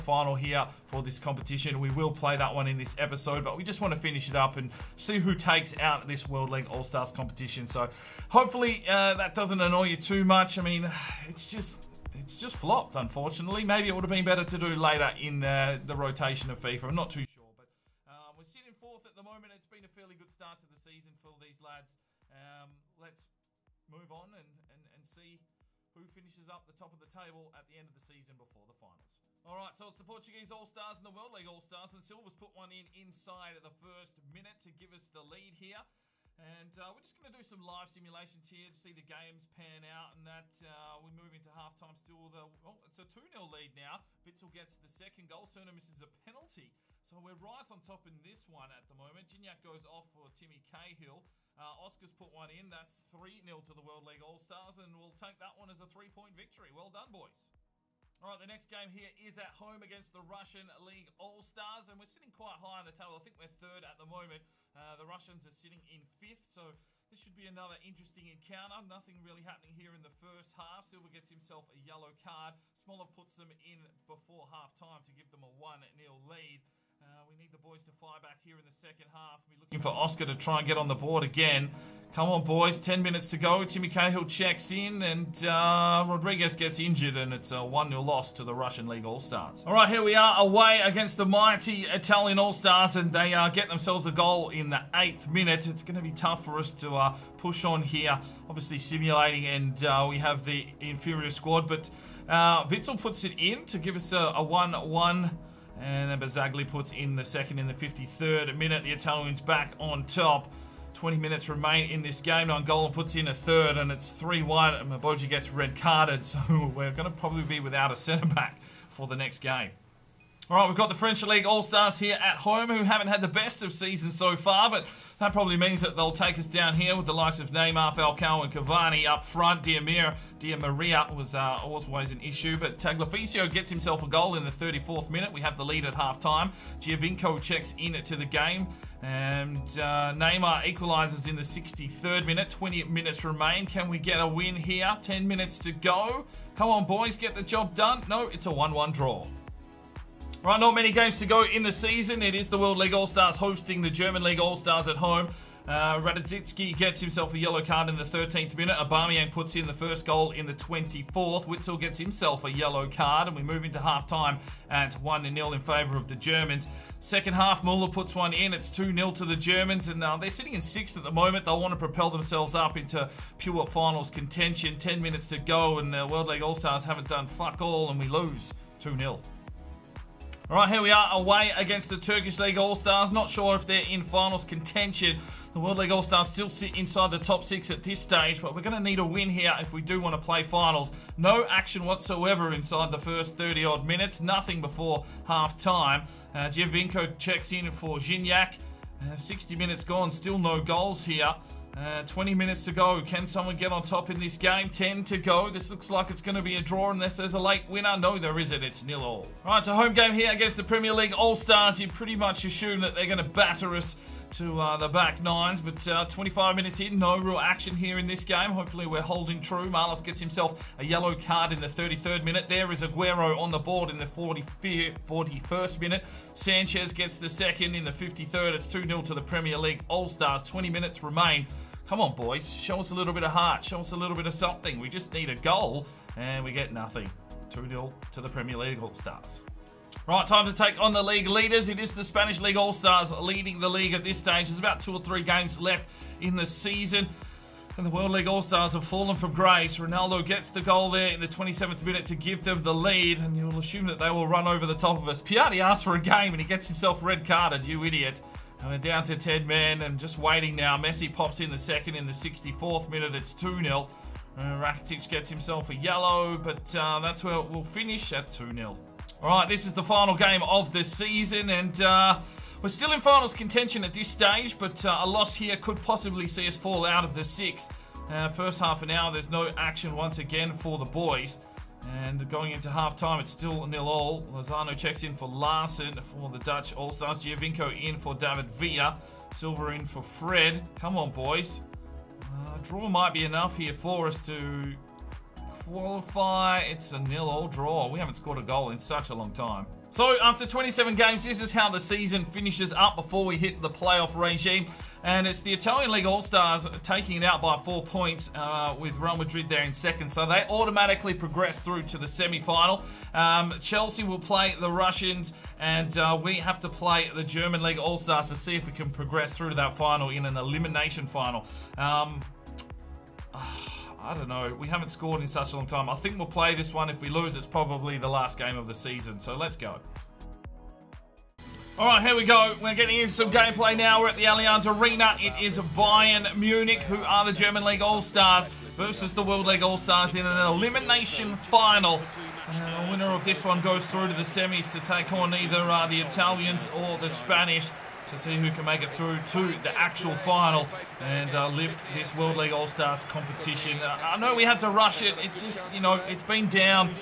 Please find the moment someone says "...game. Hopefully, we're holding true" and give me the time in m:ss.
3:38.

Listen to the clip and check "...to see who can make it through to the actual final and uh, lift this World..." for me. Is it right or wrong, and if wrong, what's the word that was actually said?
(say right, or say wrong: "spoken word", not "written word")
right.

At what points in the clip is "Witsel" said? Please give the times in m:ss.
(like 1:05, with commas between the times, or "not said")
0:44, 1:42, 2:41.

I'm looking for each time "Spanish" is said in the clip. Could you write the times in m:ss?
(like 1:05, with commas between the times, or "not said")
4:02, 5:47.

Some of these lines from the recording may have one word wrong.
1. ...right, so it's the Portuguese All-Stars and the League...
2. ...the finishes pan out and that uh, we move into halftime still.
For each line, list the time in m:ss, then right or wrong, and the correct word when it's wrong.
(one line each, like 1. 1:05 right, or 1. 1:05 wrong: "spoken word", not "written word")
1. 0:29 wrong: "World", not "League"
2. 0:38 wrong: "games", not "finishes".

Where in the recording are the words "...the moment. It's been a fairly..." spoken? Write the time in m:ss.
0:19.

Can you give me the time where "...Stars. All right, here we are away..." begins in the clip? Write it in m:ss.
1:29.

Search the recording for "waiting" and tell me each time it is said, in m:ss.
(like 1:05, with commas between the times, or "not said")
4:20.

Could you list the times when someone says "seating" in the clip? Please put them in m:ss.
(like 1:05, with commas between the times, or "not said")
not said.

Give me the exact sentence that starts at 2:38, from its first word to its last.
Aubameyang puts in the first goal in the 24th.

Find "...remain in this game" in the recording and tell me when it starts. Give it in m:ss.
1:51.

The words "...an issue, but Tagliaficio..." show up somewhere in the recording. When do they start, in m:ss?
2:12.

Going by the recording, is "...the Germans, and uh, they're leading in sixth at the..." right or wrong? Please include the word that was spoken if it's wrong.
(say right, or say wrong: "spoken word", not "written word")
wrong: "sitting", not "leading".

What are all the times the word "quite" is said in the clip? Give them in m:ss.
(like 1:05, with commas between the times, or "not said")
1:02.